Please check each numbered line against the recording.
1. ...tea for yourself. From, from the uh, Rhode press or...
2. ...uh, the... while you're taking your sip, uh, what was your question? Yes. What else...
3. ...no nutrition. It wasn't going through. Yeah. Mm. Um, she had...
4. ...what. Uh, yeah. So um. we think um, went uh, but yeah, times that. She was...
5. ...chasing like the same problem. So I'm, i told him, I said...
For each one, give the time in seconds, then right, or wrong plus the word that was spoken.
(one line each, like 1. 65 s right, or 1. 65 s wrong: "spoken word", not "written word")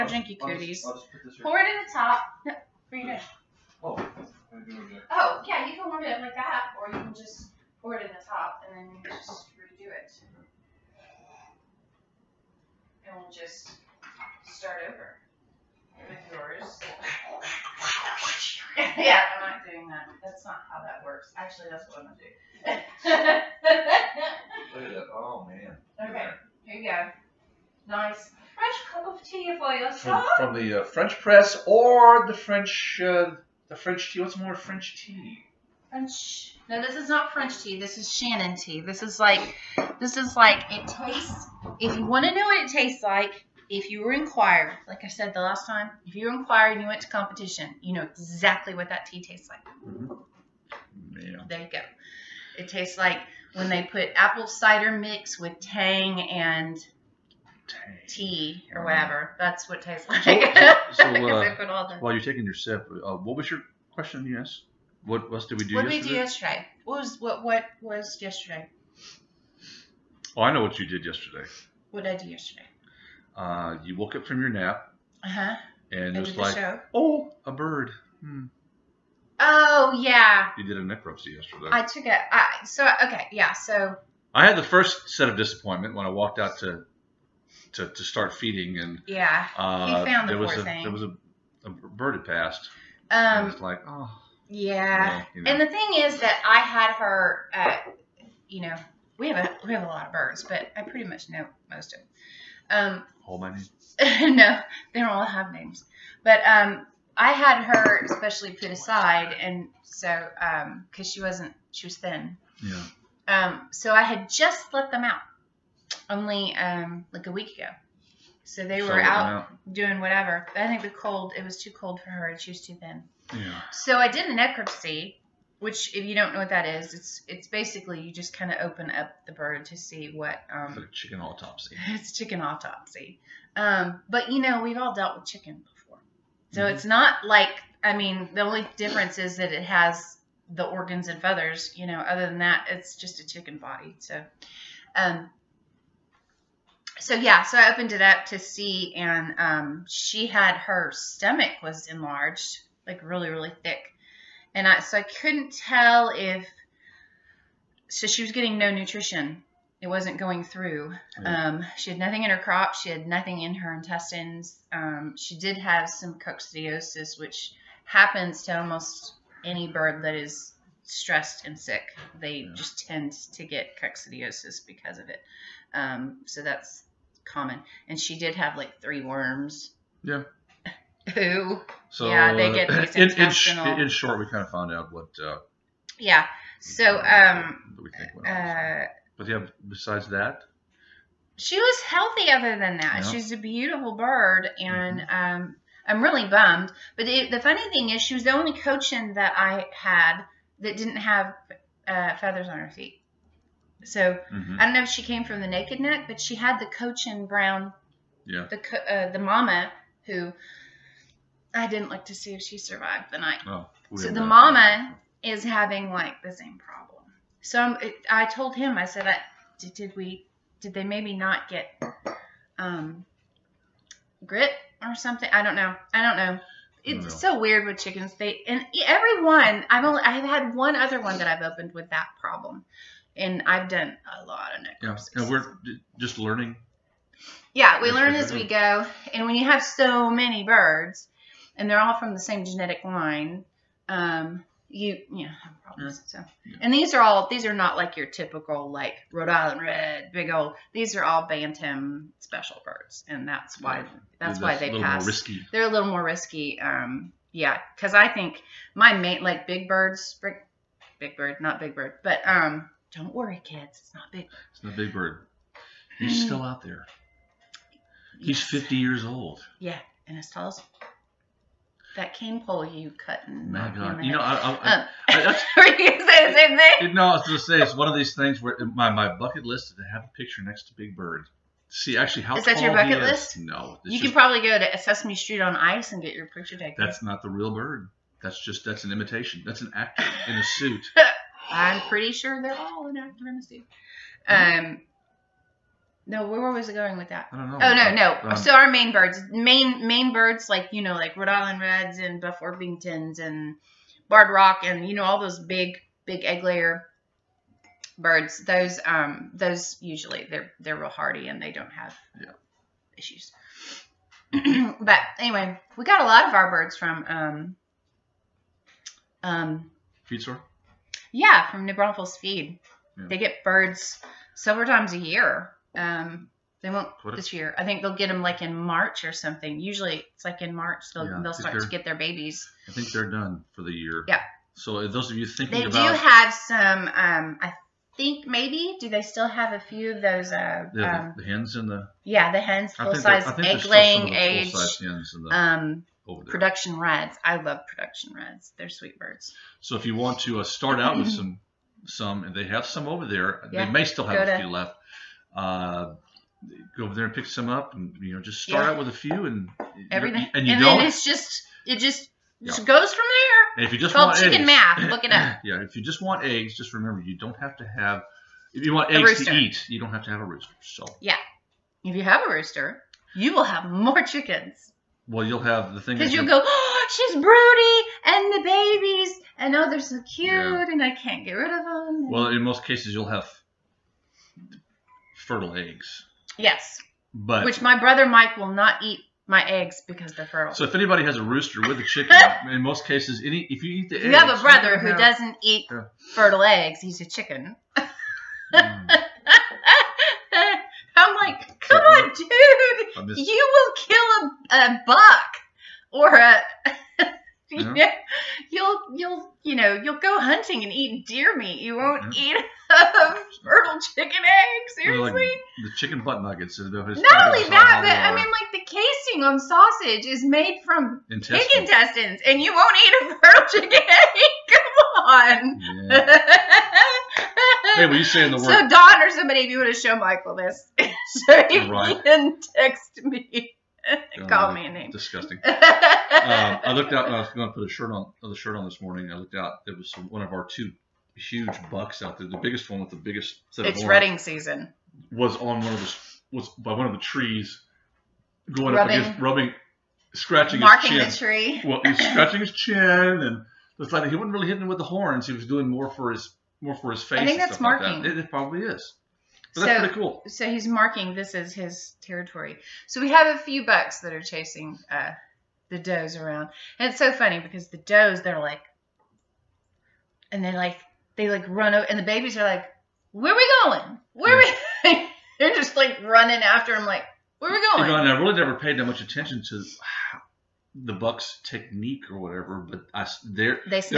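1. 29 s wrong: "French", not "Rhode"
2. 61 s right
3. 158 s right
4. 184 s wrong: "besides", not "times"
5. 215 s wrong: "having", not "chasing".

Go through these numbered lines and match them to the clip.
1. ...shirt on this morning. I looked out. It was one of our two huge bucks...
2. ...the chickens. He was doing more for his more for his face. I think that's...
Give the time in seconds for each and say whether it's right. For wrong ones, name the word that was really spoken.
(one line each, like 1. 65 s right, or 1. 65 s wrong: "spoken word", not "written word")
1. 438 s right
2. 454 s wrong: "horns", not "chickens".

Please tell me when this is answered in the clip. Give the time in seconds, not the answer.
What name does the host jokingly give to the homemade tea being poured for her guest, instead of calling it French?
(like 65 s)
38 s.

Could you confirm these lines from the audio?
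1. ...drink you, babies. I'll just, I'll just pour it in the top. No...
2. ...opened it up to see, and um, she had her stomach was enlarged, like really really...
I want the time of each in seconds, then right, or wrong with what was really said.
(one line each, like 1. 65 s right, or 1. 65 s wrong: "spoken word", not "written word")
1. 0 s wrong: "cooties", not "babies"
2. 147 s right.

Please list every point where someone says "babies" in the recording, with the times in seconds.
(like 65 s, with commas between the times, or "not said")
331 s, 378 s, 472 s.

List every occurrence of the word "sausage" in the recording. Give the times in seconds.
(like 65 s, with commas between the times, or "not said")
419 s.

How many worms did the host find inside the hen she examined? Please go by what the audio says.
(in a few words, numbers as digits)
3.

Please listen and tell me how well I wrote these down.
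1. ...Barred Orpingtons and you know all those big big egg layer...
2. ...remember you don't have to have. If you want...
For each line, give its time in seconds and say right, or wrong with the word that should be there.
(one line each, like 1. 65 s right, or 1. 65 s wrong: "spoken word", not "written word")
1. 304 s wrong: "Rock", not "Orpingtons"
2. 366 s right.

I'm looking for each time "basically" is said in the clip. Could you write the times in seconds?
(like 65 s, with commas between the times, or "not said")
127 s.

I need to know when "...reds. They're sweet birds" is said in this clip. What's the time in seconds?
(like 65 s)
348 s.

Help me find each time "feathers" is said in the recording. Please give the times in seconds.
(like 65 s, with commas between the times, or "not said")
141 s, 202 s.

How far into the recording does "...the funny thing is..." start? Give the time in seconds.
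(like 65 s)
197 s.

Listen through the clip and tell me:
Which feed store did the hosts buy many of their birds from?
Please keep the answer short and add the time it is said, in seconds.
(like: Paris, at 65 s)
New Braunfels Feed, at 321 s.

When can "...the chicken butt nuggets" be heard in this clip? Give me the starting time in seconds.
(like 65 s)
415 s.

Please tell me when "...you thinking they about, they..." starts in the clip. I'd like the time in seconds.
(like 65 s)
335 s.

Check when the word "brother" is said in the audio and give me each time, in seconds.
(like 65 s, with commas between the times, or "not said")
387 s, 394 s.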